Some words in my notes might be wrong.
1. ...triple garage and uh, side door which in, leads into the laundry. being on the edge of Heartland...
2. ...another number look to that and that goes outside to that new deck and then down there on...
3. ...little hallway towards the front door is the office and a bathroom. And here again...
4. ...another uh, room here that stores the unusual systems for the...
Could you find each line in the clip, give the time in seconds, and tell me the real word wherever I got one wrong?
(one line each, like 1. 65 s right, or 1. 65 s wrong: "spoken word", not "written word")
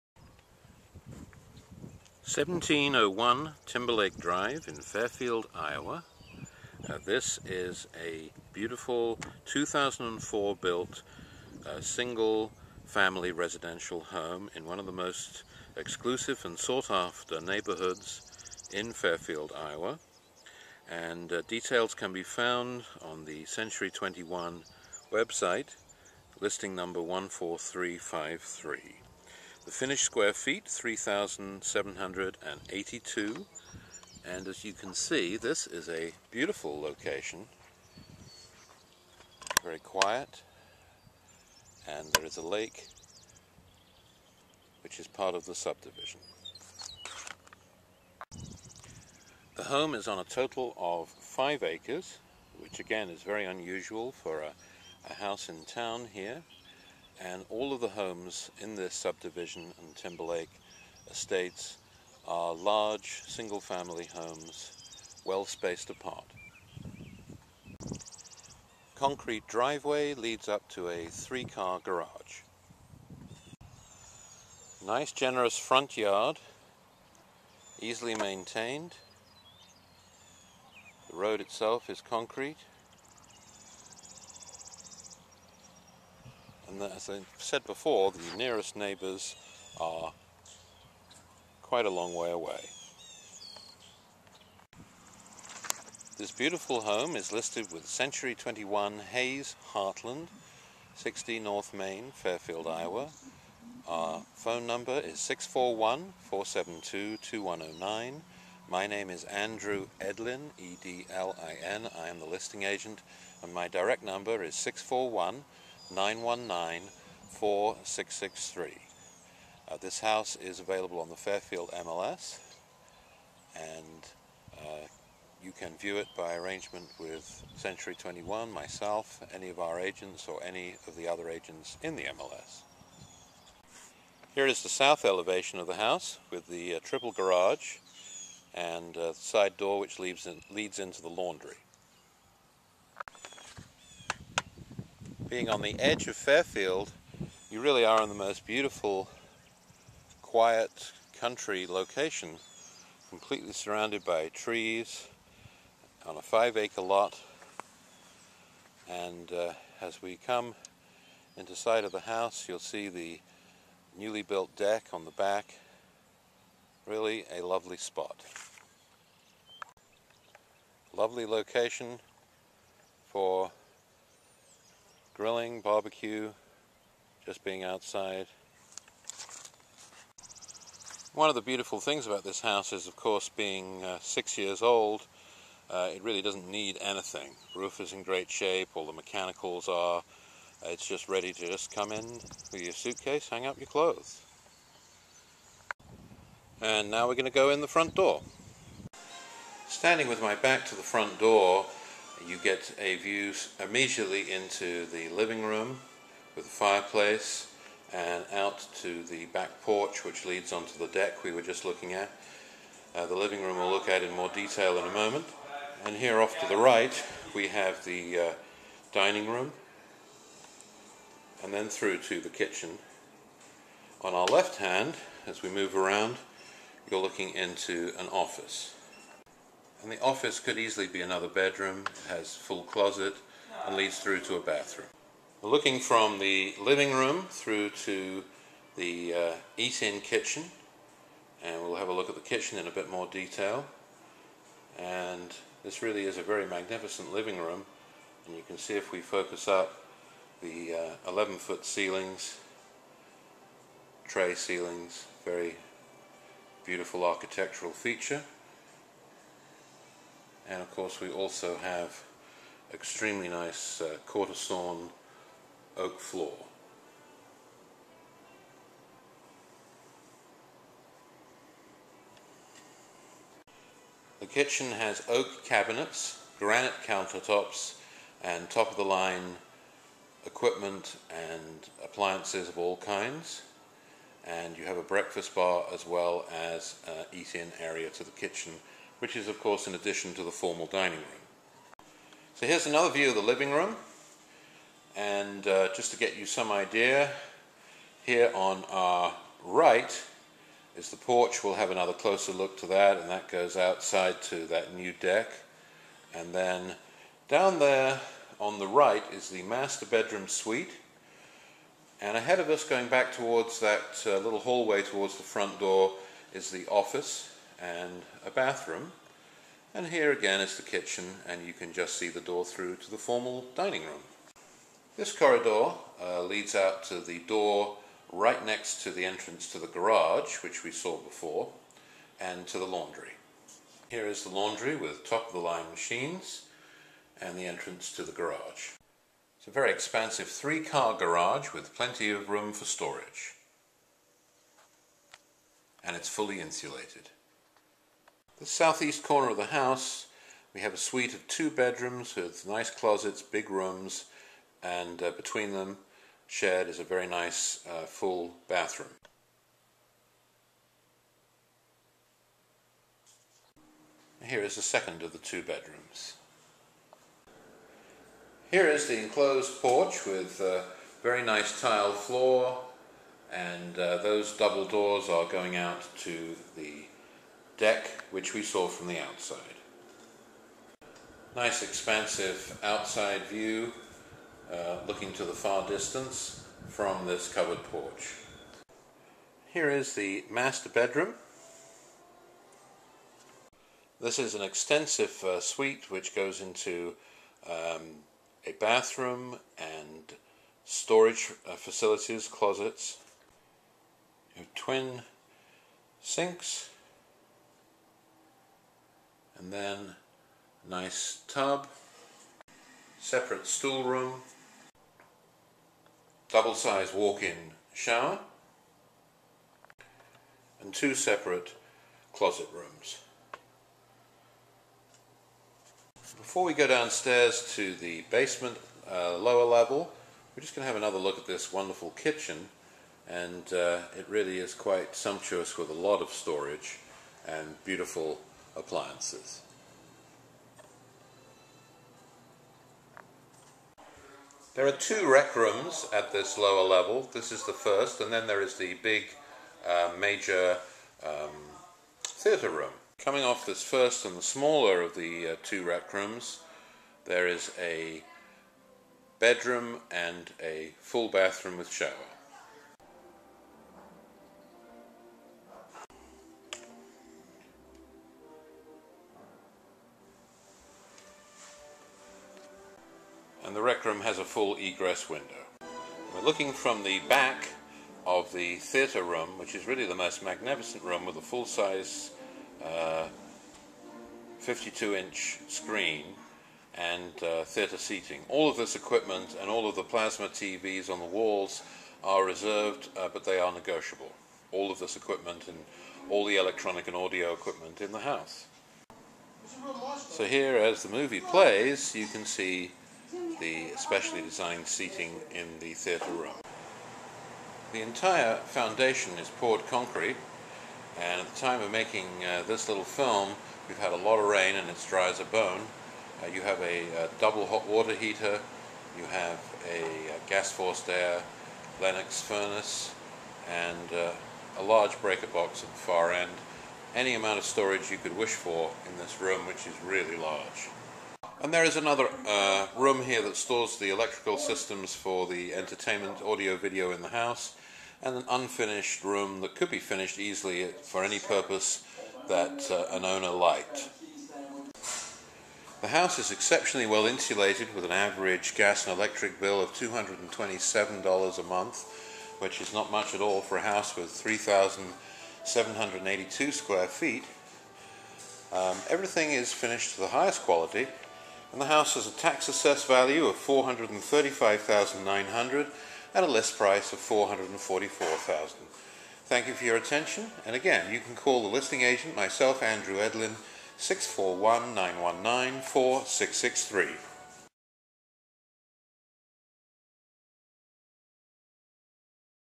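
1. 136 s wrong: "Fairfield", not "Heartland"
2. 301 s wrong: "closer", not "number"
3. 314 s right
4. 531 s wrong: "electrical", not "unusual".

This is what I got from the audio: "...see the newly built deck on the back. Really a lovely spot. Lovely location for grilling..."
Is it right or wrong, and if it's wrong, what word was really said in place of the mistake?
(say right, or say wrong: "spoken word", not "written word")
right.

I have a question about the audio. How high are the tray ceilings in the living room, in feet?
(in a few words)
11.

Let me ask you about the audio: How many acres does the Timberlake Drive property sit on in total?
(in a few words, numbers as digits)
5.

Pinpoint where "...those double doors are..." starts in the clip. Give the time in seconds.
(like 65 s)
373 s.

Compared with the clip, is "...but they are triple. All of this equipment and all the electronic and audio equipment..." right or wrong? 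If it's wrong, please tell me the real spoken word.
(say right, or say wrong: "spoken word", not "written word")
wrong: "negotiable", not "triple".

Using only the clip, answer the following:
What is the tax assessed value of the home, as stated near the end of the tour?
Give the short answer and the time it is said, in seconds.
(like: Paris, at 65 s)
435,900, at 563 s.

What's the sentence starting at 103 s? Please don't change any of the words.
Our phone number is 641 472 2109.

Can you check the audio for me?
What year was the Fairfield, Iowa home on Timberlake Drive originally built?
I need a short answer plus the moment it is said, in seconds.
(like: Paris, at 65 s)
2004, at 9 s.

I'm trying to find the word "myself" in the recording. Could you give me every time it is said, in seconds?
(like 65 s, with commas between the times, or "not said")
128 s, 572 s.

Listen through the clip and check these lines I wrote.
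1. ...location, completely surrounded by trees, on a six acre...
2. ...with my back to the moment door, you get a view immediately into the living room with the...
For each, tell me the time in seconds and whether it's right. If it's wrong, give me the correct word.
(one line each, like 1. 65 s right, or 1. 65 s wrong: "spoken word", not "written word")
1. 151 s wrong: "five", not "six"
2. 200 s wrong: "front", not "moment".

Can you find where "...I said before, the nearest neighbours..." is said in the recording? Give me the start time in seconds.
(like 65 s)
87 s.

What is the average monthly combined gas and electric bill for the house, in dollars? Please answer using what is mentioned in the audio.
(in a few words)
$227.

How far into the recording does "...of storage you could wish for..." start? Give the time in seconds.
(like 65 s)
527 s.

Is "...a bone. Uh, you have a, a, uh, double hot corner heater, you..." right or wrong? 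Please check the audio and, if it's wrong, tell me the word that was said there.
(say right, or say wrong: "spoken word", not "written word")
wrong: "water", not "corner".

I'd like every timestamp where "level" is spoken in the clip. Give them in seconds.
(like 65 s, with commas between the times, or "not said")
429 s, 446 s.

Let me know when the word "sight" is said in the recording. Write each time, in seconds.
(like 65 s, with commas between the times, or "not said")
161 s.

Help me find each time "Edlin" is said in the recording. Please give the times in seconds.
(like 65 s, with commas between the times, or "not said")
109 s, 572 s.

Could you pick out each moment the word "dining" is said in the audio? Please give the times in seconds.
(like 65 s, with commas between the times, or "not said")
218 s, 290 s, 323 s.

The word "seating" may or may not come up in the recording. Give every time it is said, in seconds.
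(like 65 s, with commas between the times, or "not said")
487 s, 504 s.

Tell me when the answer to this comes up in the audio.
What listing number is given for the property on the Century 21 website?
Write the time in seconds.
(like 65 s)
26 s.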